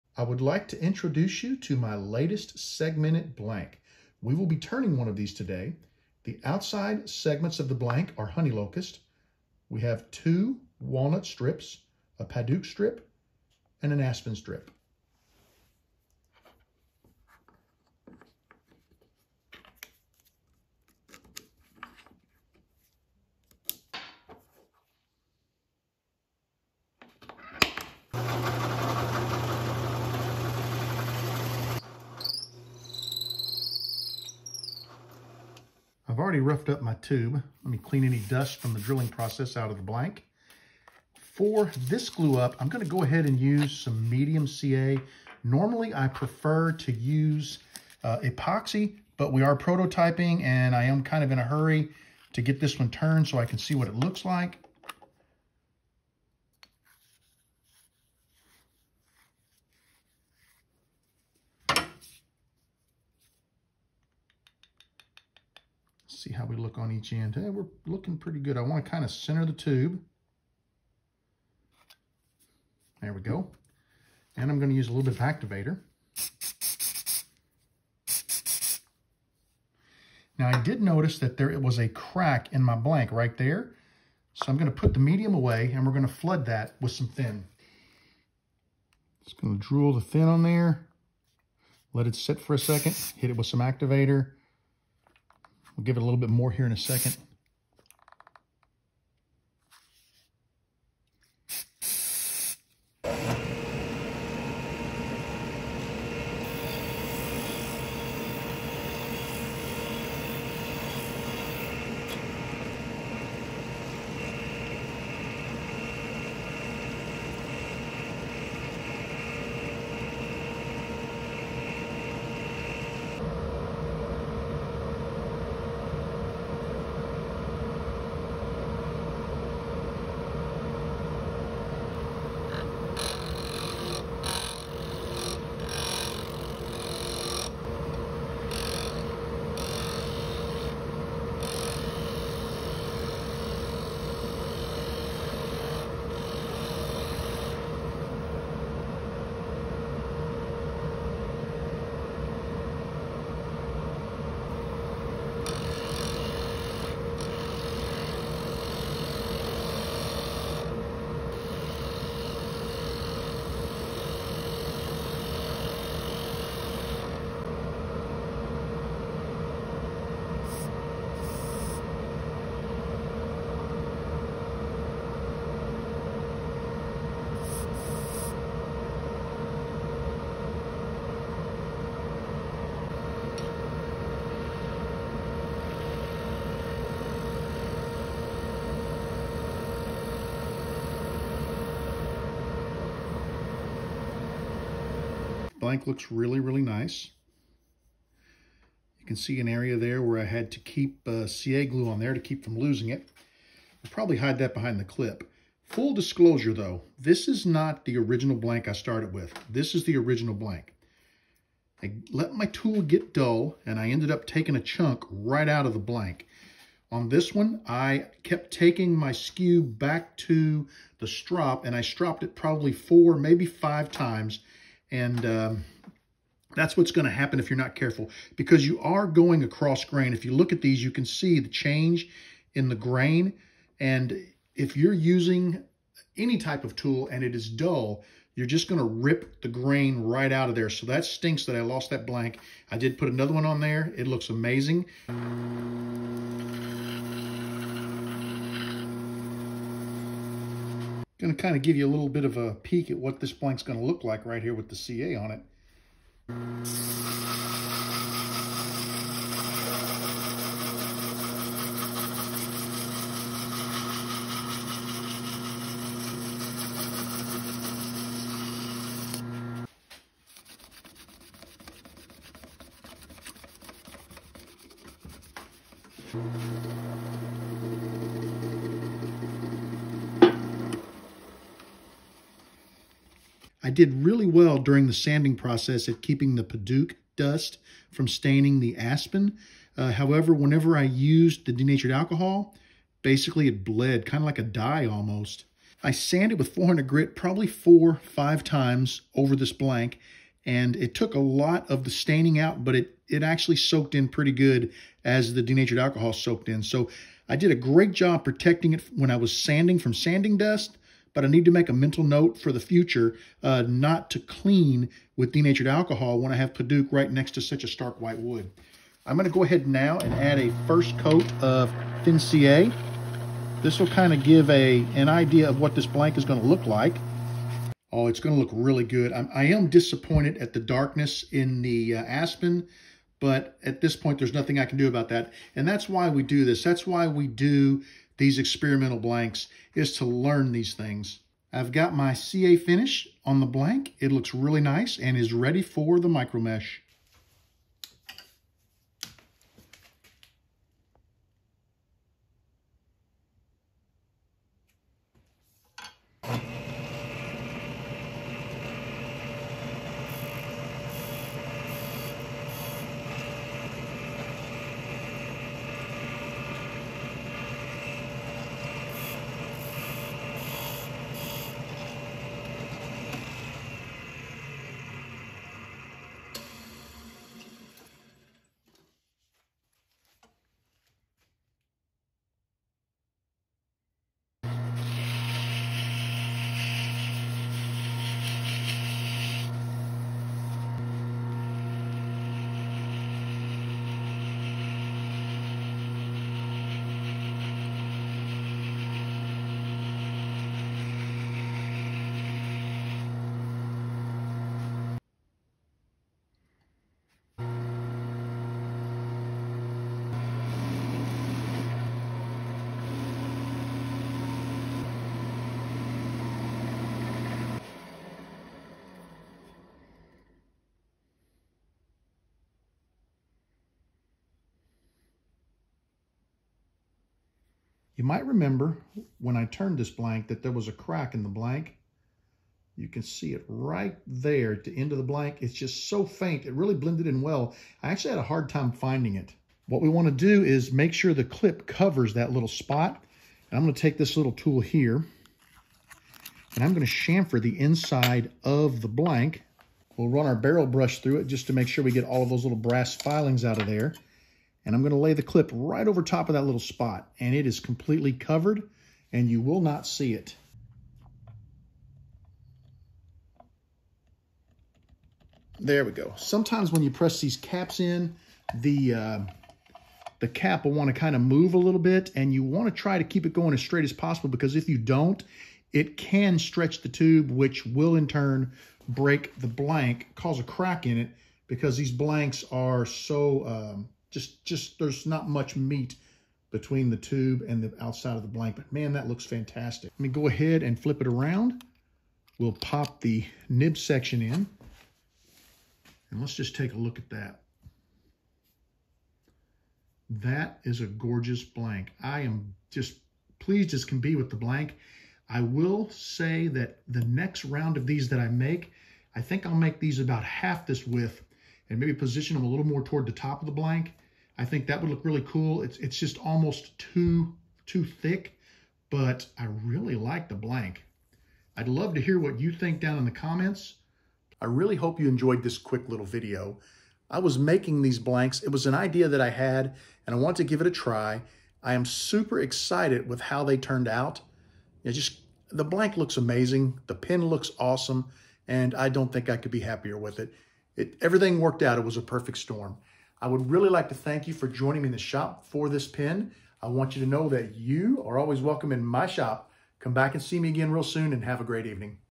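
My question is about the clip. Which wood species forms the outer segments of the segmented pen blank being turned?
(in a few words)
Honey locust.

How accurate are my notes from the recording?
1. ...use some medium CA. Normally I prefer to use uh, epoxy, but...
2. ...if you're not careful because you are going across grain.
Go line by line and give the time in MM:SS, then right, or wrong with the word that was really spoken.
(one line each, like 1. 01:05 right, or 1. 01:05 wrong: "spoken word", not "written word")
1. 00:43 right
2. 03:47 right.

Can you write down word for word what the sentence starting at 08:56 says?
The pen looks awesome, and I don't think I could be happier with it.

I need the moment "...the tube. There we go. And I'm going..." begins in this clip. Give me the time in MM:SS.
01:09.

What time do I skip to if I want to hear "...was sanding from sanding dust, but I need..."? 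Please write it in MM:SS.
05:09.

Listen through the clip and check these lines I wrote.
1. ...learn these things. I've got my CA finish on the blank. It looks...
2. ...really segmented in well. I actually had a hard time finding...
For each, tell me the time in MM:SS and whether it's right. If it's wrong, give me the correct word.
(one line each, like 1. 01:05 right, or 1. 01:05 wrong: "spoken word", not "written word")
1. 05:40 right
2. 07:16 wrong: "blended", not "segmented".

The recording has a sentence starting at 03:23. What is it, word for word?
I'll probably hide that behind the clip.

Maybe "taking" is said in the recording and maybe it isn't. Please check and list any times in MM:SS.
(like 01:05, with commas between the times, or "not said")
03:34, 03:38.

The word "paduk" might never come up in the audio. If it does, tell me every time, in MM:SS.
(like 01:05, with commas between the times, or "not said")
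00:12, 05:16.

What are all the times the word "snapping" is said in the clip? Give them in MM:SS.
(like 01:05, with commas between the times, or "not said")
not said.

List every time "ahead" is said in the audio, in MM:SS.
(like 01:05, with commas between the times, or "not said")
00:43, 05:19, 08:10.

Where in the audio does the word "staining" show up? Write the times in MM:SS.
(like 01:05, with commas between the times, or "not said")
04:48, 05:01.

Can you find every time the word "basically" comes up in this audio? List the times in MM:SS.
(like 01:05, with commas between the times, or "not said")
04:53.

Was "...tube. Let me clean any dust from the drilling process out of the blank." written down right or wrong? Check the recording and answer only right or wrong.
right.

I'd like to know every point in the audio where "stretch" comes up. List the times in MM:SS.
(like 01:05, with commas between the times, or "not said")
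07:56.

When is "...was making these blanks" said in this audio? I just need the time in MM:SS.
08:47.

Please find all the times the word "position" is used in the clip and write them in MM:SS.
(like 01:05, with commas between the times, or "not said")
08:31.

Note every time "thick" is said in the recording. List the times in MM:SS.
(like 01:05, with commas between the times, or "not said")
08:37.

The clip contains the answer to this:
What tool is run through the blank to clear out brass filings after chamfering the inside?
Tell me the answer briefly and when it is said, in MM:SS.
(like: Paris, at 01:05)
Barrel brush, at 07:30.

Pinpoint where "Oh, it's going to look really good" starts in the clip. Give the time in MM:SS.
05:27.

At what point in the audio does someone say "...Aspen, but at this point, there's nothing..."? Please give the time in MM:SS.
05:32.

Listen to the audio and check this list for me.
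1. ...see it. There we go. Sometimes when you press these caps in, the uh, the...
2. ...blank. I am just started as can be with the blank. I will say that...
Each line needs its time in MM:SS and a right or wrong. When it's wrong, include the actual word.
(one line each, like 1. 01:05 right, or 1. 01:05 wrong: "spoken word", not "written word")
1. 07:39 right
2. 08:21 wrong: "pleased", not "started".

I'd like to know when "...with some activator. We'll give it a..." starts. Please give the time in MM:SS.
01:33.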